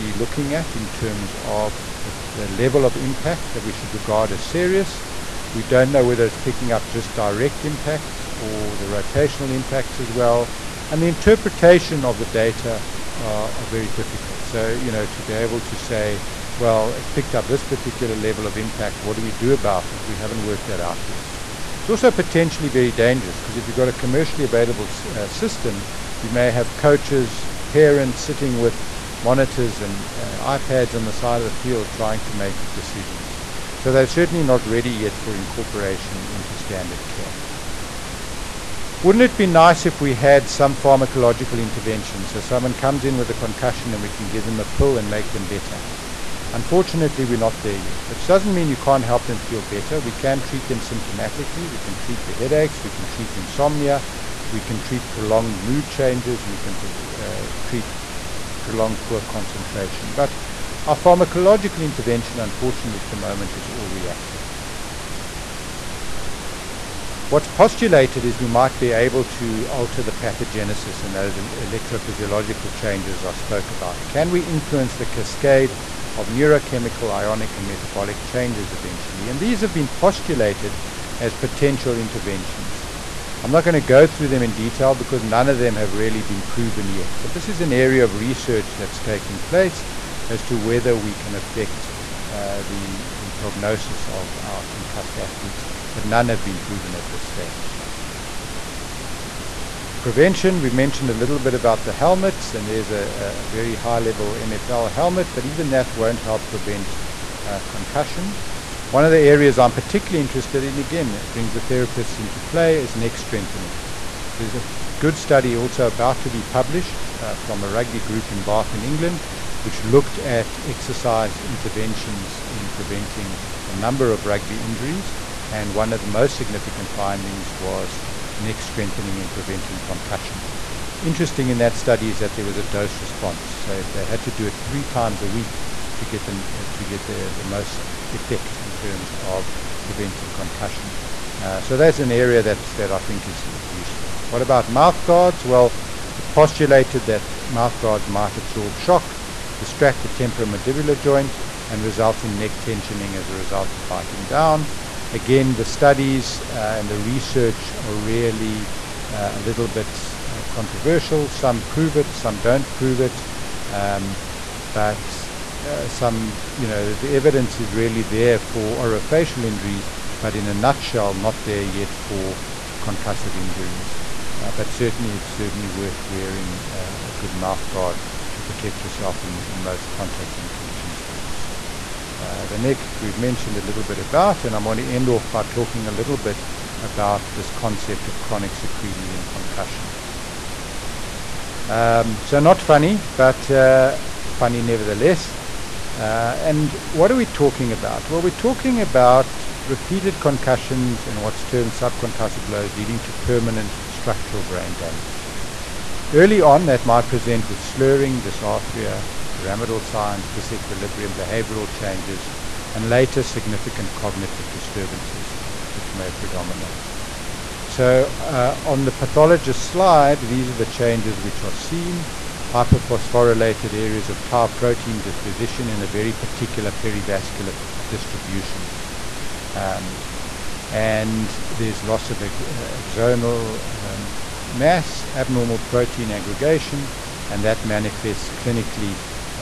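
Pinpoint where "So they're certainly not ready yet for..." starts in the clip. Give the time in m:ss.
0:33.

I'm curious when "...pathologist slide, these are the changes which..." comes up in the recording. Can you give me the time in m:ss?
3:38.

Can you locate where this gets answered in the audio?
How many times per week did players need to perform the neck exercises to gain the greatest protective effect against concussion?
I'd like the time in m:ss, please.
2:14.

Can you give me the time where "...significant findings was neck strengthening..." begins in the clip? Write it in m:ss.
2:06.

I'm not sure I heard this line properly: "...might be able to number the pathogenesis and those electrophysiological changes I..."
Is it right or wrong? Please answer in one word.
wrong.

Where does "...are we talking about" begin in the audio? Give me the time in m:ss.
3:17.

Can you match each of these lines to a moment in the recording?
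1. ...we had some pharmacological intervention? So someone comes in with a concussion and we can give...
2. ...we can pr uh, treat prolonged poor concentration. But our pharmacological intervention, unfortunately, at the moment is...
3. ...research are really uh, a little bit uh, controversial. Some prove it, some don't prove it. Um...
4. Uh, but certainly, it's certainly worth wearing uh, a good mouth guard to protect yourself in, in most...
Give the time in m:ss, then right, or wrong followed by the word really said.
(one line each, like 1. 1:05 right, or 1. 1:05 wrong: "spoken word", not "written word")
1. 0:39 right
2. 0:56 right
3. 2:36 right
4. 2:54 right.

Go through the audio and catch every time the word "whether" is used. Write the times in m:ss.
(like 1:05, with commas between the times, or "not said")
0:06, 1:30.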